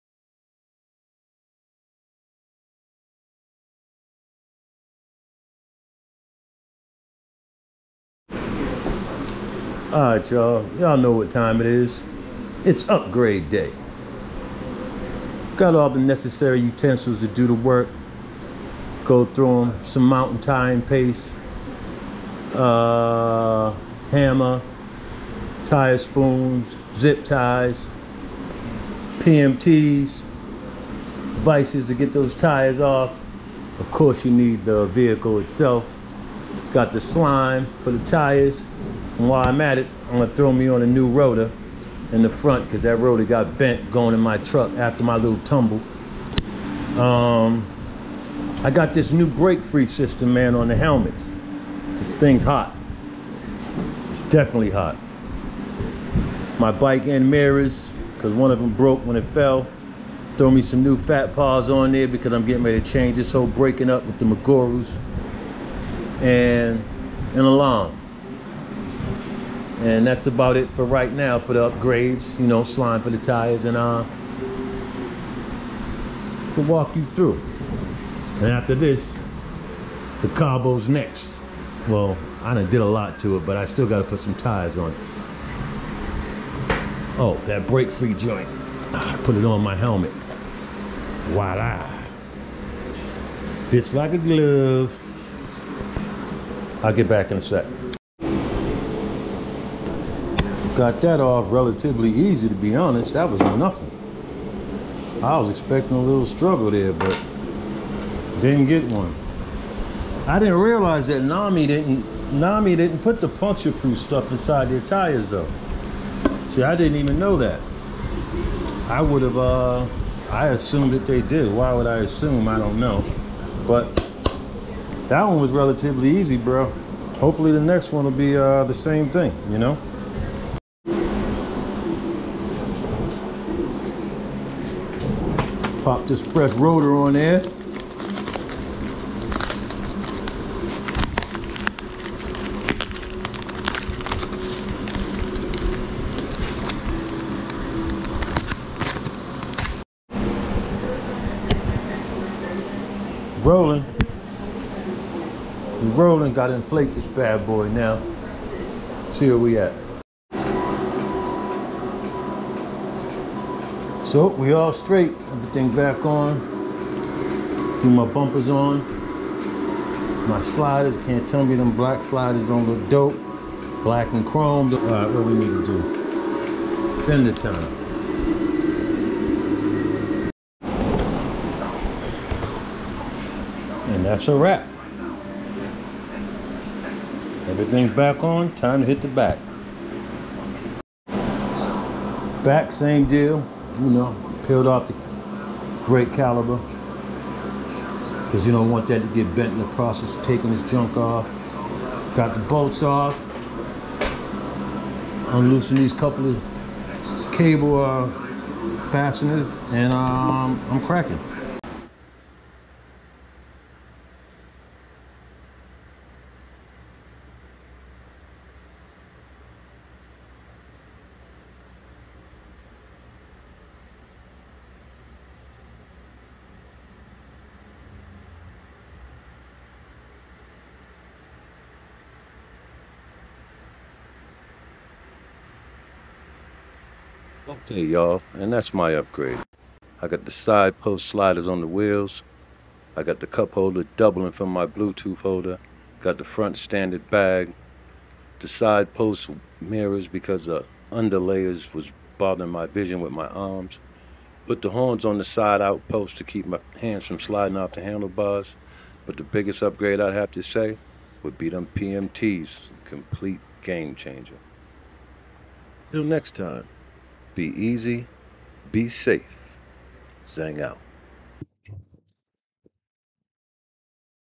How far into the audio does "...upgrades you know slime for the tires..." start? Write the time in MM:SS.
01:11.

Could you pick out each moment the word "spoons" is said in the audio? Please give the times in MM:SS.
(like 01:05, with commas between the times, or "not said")
00:25.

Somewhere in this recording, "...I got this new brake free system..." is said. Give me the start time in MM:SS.
00:48.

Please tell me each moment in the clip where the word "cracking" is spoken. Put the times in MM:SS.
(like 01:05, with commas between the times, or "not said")
03:30.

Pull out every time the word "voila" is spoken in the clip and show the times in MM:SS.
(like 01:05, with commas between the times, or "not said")
01:31.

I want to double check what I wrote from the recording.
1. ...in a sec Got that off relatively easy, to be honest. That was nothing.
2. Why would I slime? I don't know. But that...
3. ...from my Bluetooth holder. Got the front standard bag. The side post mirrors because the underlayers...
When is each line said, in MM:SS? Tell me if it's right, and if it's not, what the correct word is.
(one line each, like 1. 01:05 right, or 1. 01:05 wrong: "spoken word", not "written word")
1. 01:37 right
2. 02:01 wrong: "assume", not "slime"
3. 04:04 right.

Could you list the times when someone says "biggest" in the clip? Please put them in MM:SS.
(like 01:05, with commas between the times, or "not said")
04:19.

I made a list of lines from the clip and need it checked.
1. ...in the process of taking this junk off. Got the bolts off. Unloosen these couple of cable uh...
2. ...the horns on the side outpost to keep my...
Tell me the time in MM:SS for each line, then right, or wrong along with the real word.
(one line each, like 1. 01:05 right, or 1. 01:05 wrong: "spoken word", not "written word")
1. 03:19 right
2. 04:14 right.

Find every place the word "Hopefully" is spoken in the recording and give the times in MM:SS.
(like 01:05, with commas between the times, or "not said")
02:07.